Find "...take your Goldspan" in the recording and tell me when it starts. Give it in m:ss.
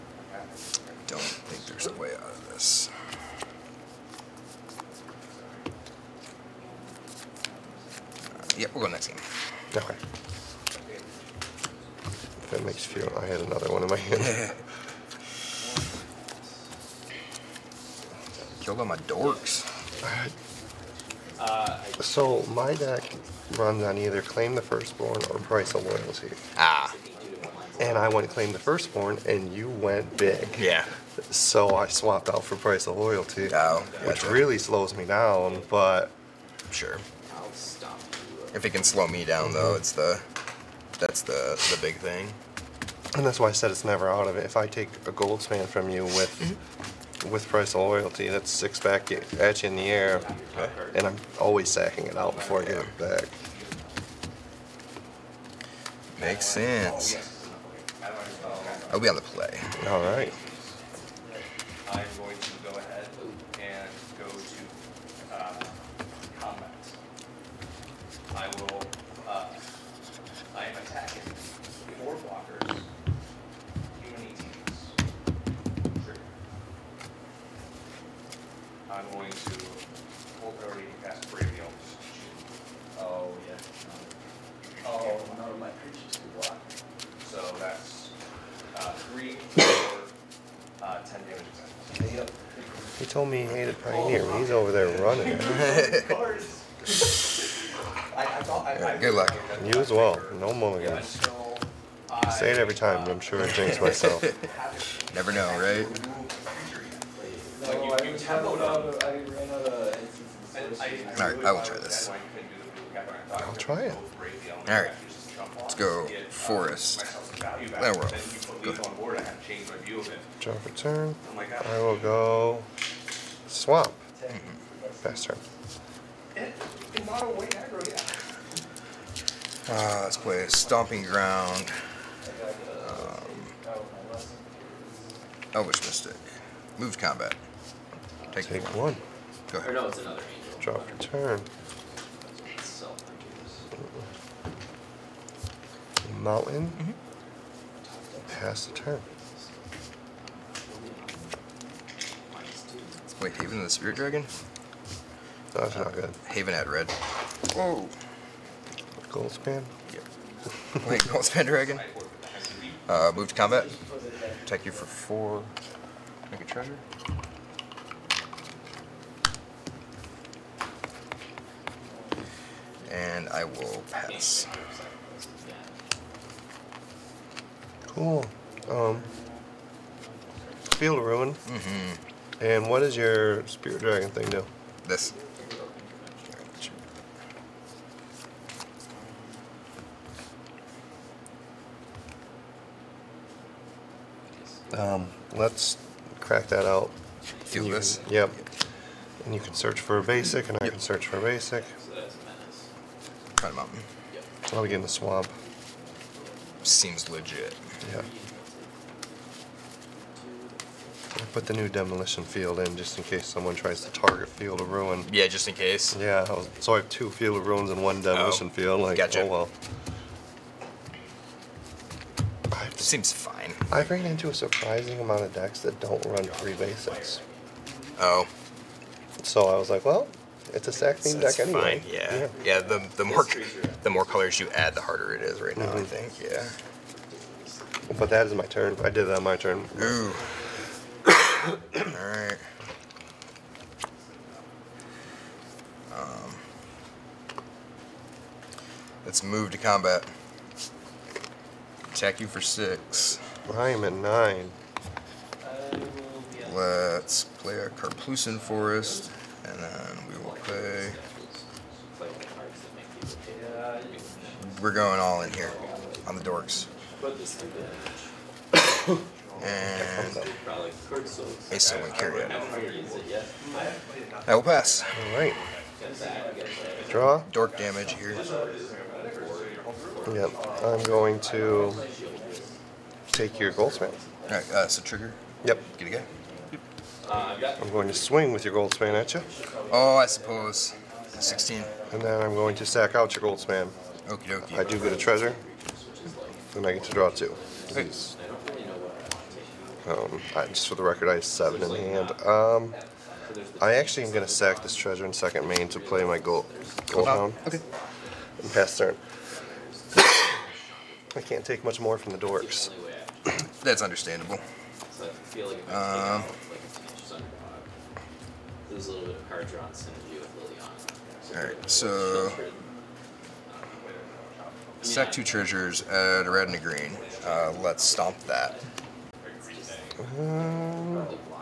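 4:43.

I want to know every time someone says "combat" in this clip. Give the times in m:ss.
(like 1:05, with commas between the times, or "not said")
2:16, 2:43, 4:09.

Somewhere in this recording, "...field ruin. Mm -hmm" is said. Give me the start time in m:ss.
3:00.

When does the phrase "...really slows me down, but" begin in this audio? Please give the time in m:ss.
0:34.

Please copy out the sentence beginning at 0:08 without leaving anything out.
Uh, yep, we'll go next game.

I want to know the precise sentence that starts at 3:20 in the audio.
I can search for a basic.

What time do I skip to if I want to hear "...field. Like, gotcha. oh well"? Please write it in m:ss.
3:38.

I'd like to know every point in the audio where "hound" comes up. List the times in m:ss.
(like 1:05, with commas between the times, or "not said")
5:07.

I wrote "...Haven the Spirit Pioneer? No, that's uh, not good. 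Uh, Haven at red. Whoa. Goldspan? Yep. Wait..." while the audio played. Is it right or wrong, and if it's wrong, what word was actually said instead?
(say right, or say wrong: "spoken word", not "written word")
wrong: "Dragon", not "Pioneer".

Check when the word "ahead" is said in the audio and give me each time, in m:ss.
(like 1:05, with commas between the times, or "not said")
2:19.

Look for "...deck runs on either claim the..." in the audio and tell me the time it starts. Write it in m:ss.
0:22.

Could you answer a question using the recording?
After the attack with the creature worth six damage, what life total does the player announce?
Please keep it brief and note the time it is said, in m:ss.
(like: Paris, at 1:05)
9, at 4:13.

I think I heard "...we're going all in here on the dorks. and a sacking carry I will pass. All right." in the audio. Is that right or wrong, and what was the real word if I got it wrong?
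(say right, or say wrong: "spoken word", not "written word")
wrong: "sewing", not "sacking".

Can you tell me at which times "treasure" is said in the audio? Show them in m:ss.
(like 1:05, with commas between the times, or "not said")
2:46, 4:54, 5:04, 5:25.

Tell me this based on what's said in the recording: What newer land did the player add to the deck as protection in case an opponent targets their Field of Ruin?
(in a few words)
Demolition Field.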